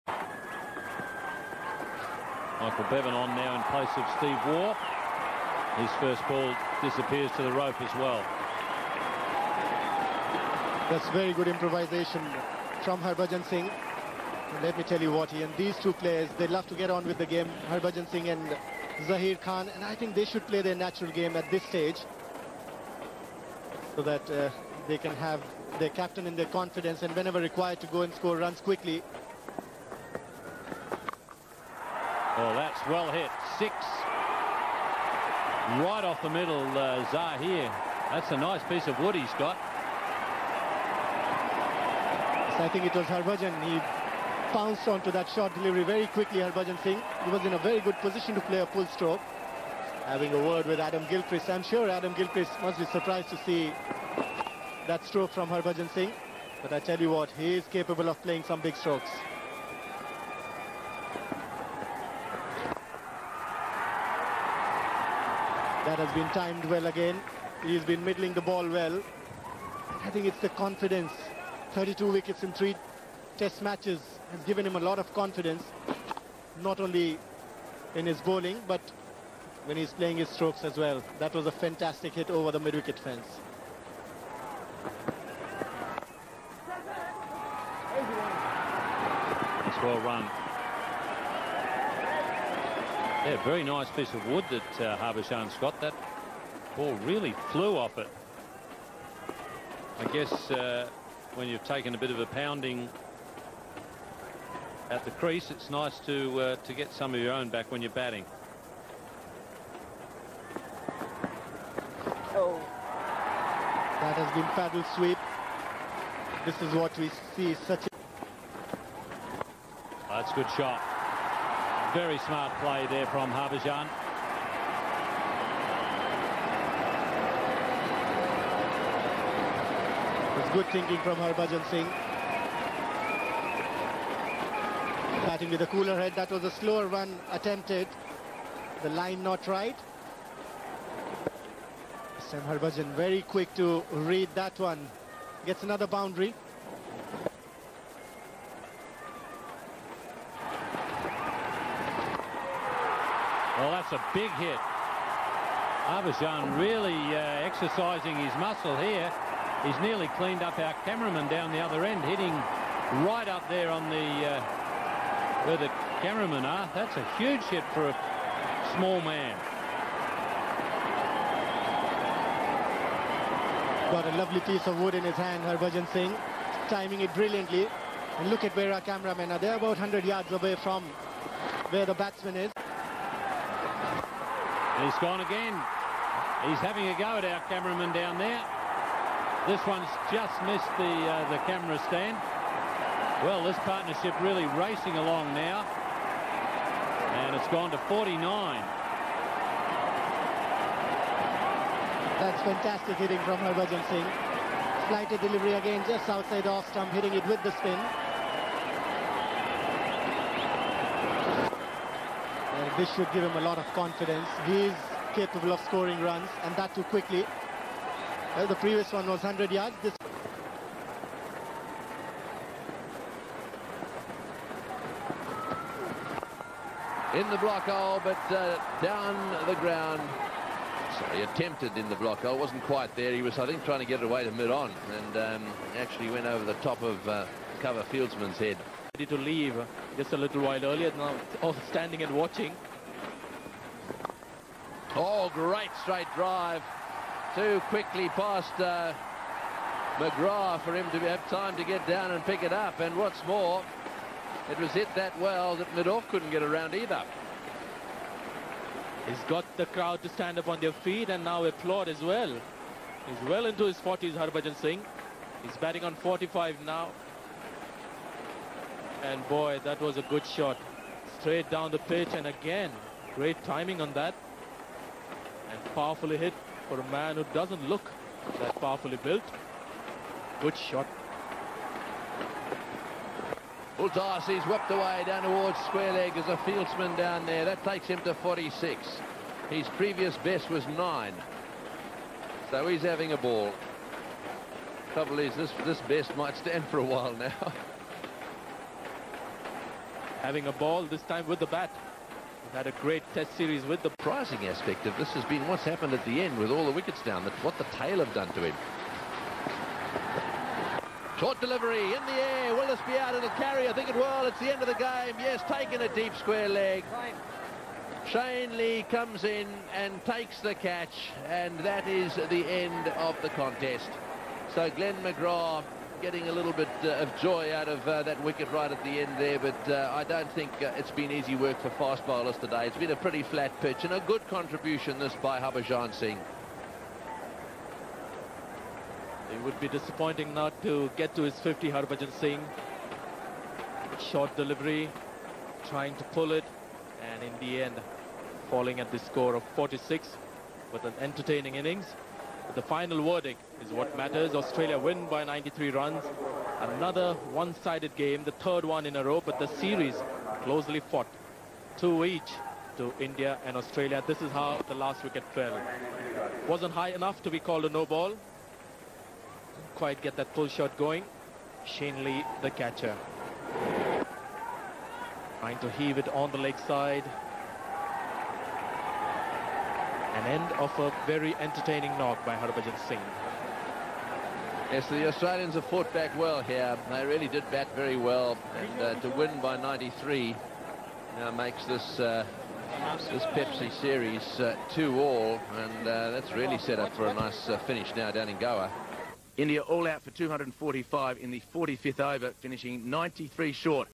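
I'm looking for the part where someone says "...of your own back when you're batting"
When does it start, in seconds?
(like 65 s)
107 s.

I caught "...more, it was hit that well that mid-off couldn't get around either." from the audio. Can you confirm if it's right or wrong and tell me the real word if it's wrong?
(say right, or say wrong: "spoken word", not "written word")
right.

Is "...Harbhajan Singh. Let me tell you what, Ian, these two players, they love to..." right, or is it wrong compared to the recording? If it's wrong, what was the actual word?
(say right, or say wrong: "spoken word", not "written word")
right.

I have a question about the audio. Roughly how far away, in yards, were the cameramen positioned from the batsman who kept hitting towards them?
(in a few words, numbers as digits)
100 yards.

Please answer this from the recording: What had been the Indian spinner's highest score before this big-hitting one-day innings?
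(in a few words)
9.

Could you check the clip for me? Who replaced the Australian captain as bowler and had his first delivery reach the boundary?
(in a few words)
Michael Bevan.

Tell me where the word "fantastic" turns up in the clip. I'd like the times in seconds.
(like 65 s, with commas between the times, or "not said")
81 s, 202 s.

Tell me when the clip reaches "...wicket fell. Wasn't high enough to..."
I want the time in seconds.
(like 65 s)
365 s.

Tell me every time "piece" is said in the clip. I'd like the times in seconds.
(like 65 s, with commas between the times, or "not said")
38 s, 93 s, 174 s.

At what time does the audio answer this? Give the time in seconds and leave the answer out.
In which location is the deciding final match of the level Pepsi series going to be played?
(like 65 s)
398 s.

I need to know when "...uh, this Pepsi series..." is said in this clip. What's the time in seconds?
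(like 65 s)
392 s.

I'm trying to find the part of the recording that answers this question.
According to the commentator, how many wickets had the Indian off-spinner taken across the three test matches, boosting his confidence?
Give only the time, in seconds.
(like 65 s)
71 s.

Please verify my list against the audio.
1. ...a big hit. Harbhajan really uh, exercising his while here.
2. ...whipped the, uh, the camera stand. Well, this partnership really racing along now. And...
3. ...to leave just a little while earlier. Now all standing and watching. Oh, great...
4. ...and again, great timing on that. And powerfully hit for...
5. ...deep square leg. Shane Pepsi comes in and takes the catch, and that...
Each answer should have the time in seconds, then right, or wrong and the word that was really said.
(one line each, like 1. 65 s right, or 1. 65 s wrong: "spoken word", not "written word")
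1. 153 s wrong: "muscle", not "while"
2. 190 s wrong: "missed", not "whipped"
3. 239 s right
4. 272 s right
5. 315 s wrong: "Lee", not "Pepsi".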